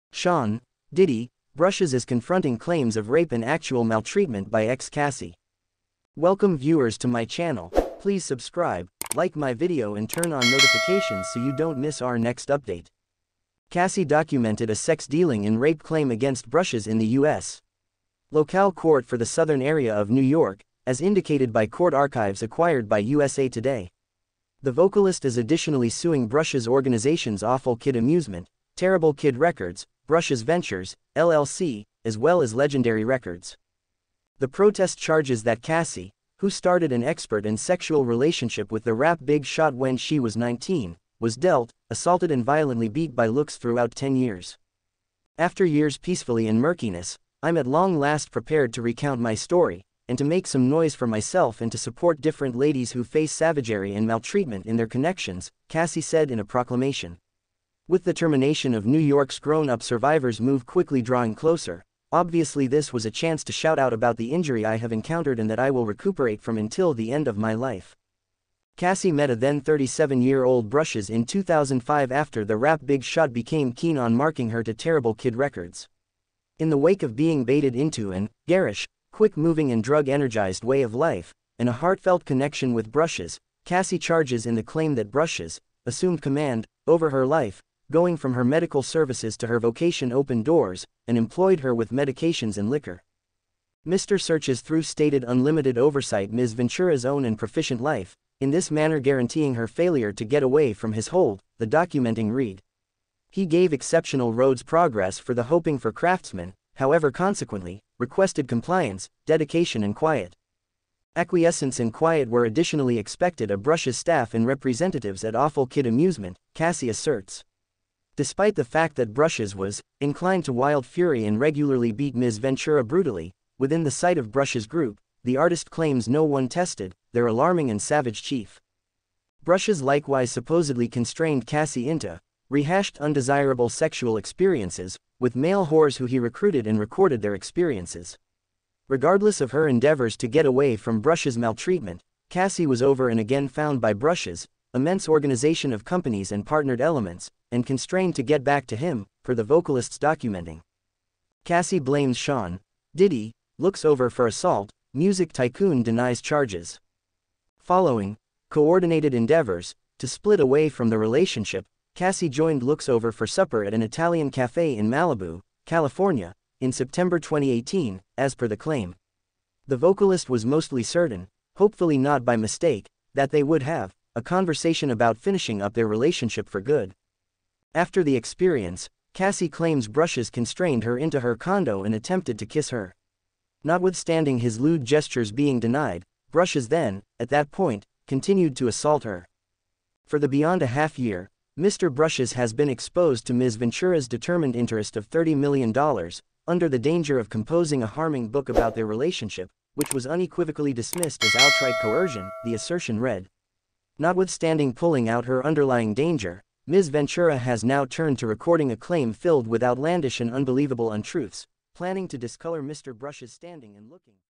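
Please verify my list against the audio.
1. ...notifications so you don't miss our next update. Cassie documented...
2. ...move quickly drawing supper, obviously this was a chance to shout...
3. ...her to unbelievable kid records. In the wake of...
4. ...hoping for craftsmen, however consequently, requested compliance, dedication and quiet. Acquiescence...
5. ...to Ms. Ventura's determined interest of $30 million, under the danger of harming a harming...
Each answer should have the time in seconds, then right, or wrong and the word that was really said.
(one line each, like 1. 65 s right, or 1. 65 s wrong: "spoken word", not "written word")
1. 10 s right
2. 60 s wrong: "closer", not "supper"
3. 74 s wrong: "terrible", not "unbelievable"
4. 105 s right
5. 193 s wrong: "composing", not "harming".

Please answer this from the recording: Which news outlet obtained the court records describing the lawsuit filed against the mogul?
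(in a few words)
USA Today.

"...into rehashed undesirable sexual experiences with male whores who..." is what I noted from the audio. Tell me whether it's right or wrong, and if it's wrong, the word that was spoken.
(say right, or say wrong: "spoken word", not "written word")
right.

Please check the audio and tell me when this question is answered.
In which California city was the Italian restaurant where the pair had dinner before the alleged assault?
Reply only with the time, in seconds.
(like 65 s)
164 s.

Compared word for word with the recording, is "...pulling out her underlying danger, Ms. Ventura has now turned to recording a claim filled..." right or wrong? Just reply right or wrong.
right.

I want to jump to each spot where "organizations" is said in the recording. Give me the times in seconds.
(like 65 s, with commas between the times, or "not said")
26 s, 145 s.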